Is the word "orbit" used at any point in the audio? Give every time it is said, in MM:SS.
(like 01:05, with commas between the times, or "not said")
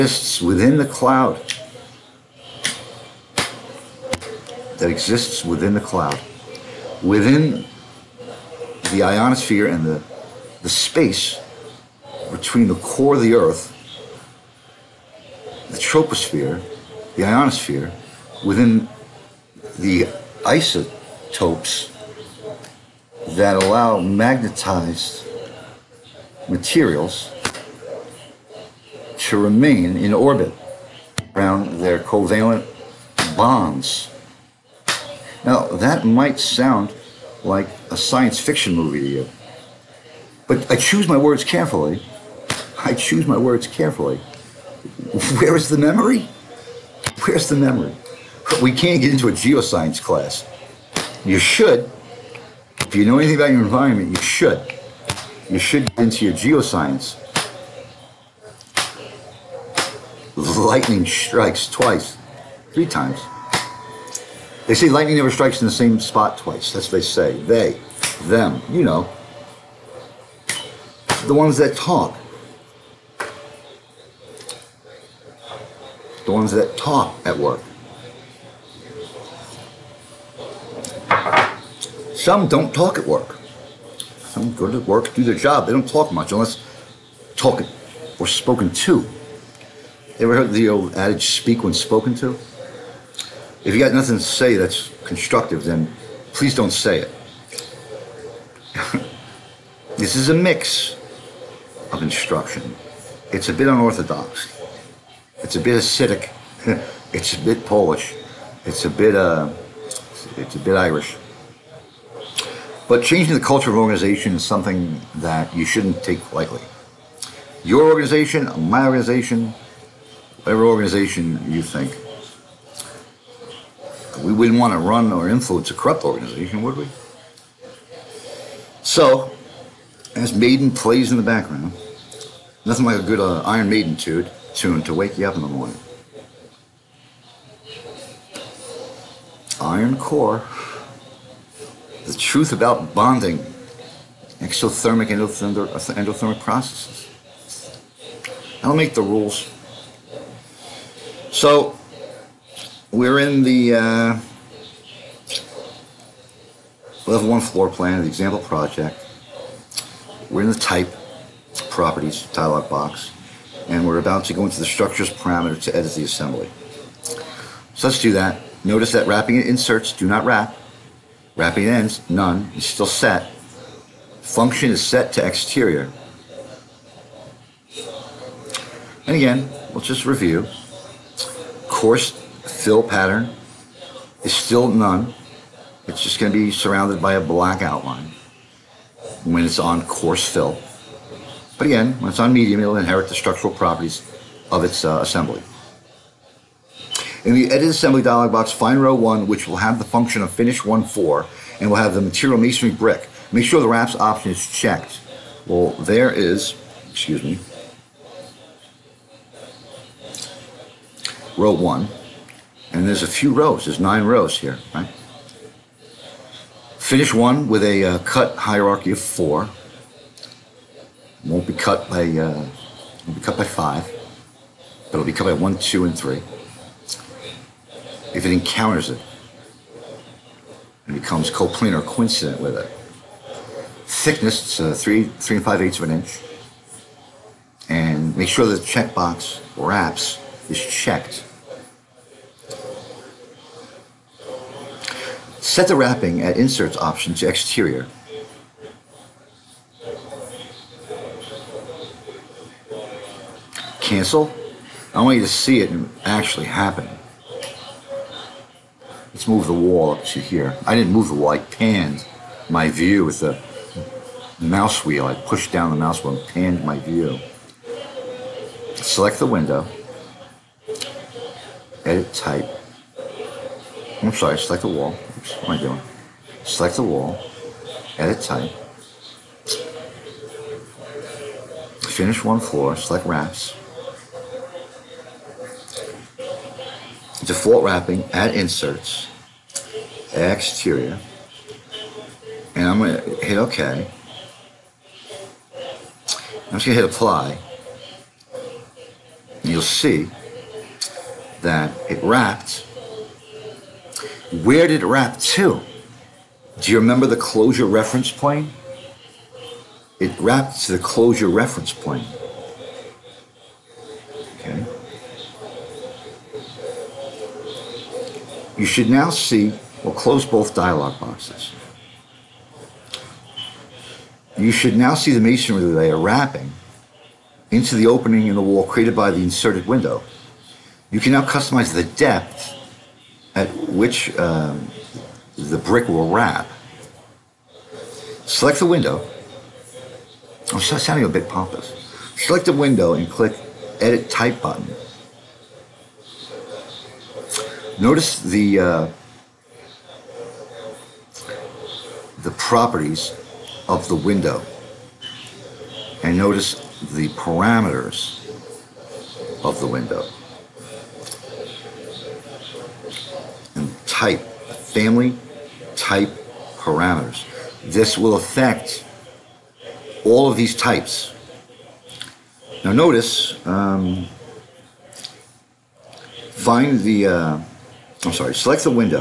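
00:30.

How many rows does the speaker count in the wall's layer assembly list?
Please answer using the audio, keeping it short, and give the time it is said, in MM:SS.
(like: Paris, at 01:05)
9, at 03:33.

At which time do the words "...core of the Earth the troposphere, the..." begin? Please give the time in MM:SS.
00:12.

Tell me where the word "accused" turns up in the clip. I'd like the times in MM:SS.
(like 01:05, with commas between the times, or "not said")
not said.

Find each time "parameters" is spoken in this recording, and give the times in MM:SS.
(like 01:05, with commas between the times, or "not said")
02:45, 05:57, 06:06.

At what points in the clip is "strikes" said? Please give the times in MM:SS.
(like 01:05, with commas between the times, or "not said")
01:01, 01:05.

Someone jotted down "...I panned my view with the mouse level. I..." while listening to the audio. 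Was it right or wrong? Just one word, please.
wrong.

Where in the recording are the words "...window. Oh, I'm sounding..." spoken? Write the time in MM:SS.
05:38.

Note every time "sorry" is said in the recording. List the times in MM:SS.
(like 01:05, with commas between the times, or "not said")
04:34, 06:18.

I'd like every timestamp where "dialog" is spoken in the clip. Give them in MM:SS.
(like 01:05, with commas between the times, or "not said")
02:42, 03:18, 05:20.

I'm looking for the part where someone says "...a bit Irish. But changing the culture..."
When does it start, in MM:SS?
01:50.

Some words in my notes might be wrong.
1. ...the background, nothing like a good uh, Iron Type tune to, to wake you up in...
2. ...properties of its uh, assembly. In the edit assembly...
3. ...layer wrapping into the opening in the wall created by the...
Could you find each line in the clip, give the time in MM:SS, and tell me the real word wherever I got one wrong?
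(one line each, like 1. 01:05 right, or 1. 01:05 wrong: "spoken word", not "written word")
1. 02:11 wrong: "Maiden", not "Type"
2. 03:13 right
3. 05:25 right.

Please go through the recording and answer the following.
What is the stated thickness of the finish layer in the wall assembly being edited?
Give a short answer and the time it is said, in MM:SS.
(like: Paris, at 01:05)
3 5/8 inch, at 03:55.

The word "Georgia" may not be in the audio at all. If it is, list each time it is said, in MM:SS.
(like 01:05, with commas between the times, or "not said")
not said.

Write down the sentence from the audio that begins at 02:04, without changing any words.
We wouldn't want to run or influence a corrupt organization, would we?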